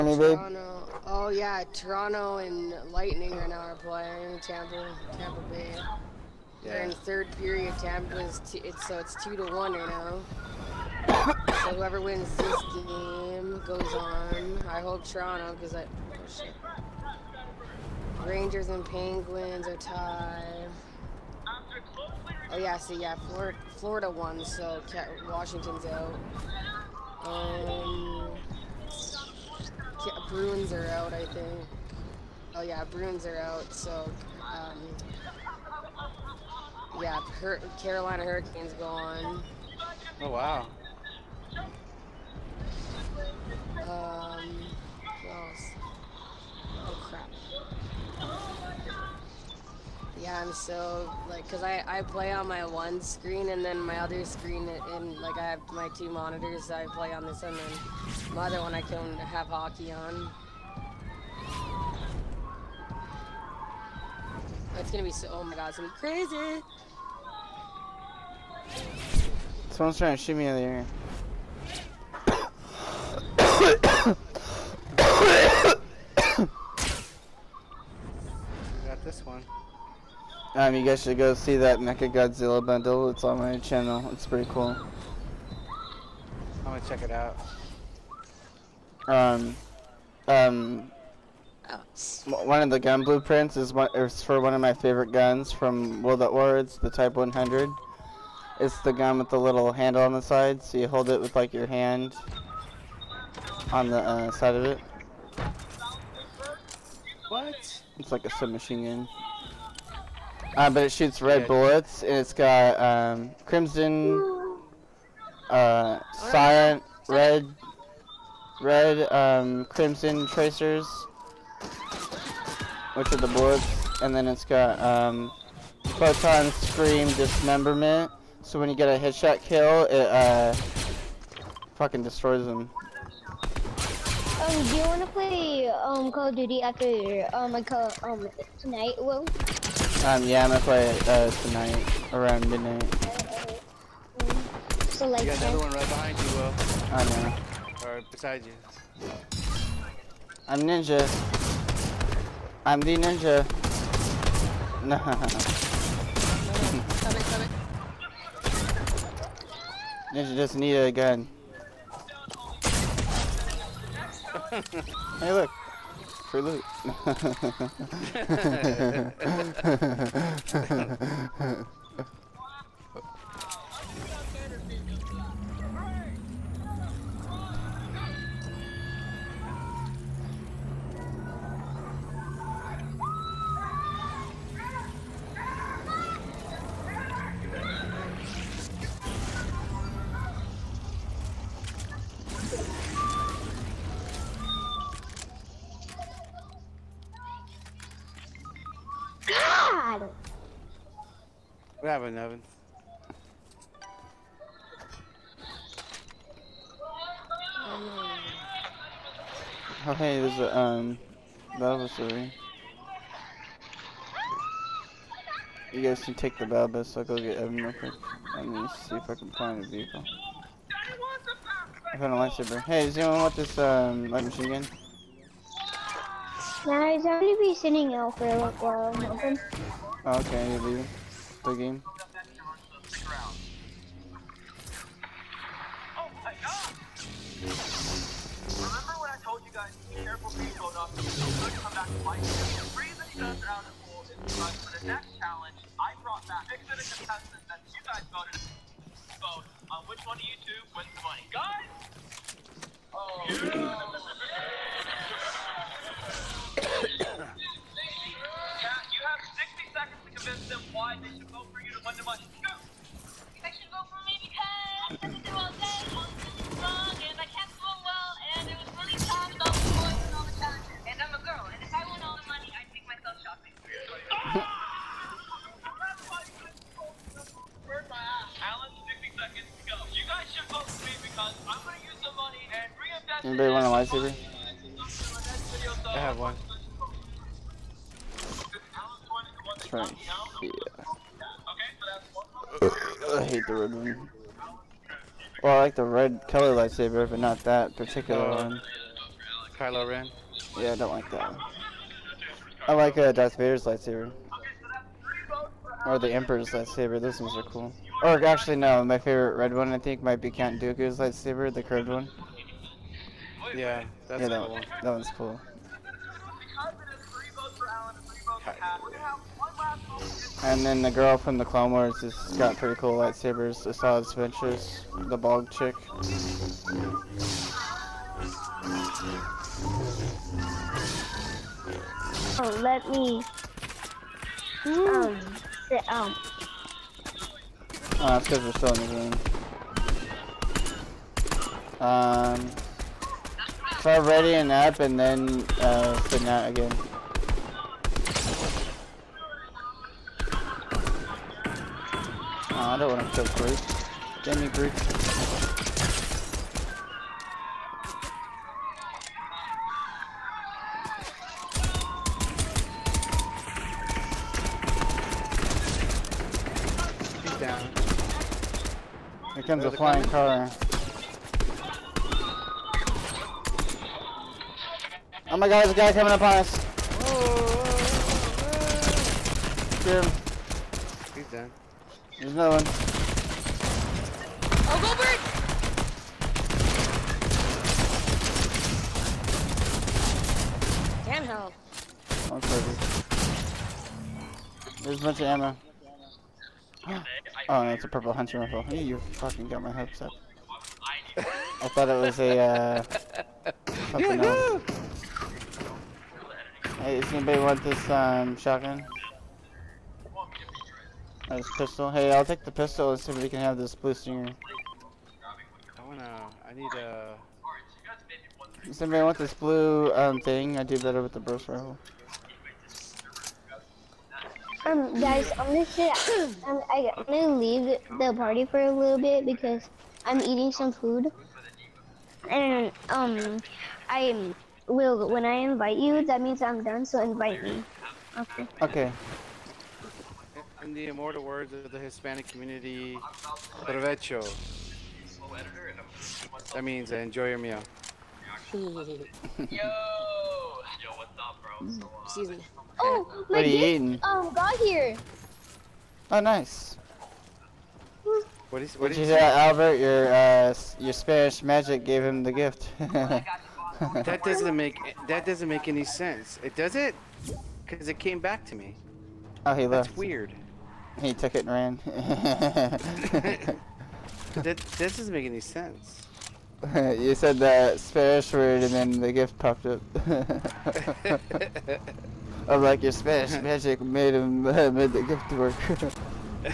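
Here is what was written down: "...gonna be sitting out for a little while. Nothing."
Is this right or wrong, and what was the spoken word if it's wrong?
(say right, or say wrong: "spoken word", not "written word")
right.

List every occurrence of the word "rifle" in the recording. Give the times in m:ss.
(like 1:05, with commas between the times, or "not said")
6:38, 7:01.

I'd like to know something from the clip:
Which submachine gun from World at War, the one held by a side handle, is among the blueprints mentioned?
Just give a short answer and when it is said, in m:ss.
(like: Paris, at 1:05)
Type 100, at 1:36.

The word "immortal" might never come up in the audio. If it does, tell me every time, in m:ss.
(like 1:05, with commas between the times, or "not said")
7:20.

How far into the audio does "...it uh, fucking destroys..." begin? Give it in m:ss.
2:09.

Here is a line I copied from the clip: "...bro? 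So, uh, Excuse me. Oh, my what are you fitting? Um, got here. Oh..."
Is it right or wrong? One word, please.
wrong.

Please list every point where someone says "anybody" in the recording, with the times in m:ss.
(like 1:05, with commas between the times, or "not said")
4:43, 6:47, 6:58.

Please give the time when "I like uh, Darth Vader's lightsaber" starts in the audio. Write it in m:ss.
5:02.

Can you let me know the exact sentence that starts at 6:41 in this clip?
I thought it was a, uh...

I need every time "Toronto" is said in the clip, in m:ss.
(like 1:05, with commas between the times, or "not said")
0:01, 0:15.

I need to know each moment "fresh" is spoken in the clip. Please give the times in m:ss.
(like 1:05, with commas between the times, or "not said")
not said.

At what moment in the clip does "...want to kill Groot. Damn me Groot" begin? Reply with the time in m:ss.
5:52.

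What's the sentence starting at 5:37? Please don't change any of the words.
Oh, that's because we're still in the game.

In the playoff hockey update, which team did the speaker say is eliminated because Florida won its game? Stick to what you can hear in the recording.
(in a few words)
Washington.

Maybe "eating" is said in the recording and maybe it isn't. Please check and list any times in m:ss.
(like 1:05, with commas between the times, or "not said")
7:10, 7:33.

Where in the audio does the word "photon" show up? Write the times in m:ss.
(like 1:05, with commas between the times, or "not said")
2:05.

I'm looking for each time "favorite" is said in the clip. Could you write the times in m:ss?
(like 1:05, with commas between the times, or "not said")
1:34, 5:08.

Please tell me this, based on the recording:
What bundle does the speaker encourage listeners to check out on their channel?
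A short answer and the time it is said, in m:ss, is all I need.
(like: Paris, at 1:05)
Mecha Godzilla bundle, at 1:21.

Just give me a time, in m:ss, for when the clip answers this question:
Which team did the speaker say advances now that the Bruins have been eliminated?
0:37.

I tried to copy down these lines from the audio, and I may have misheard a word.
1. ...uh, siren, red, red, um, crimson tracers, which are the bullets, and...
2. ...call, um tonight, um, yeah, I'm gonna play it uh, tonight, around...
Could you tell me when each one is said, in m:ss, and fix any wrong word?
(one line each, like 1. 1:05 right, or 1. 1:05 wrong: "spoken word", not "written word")
1. 1:55 right
2. 2:17 right.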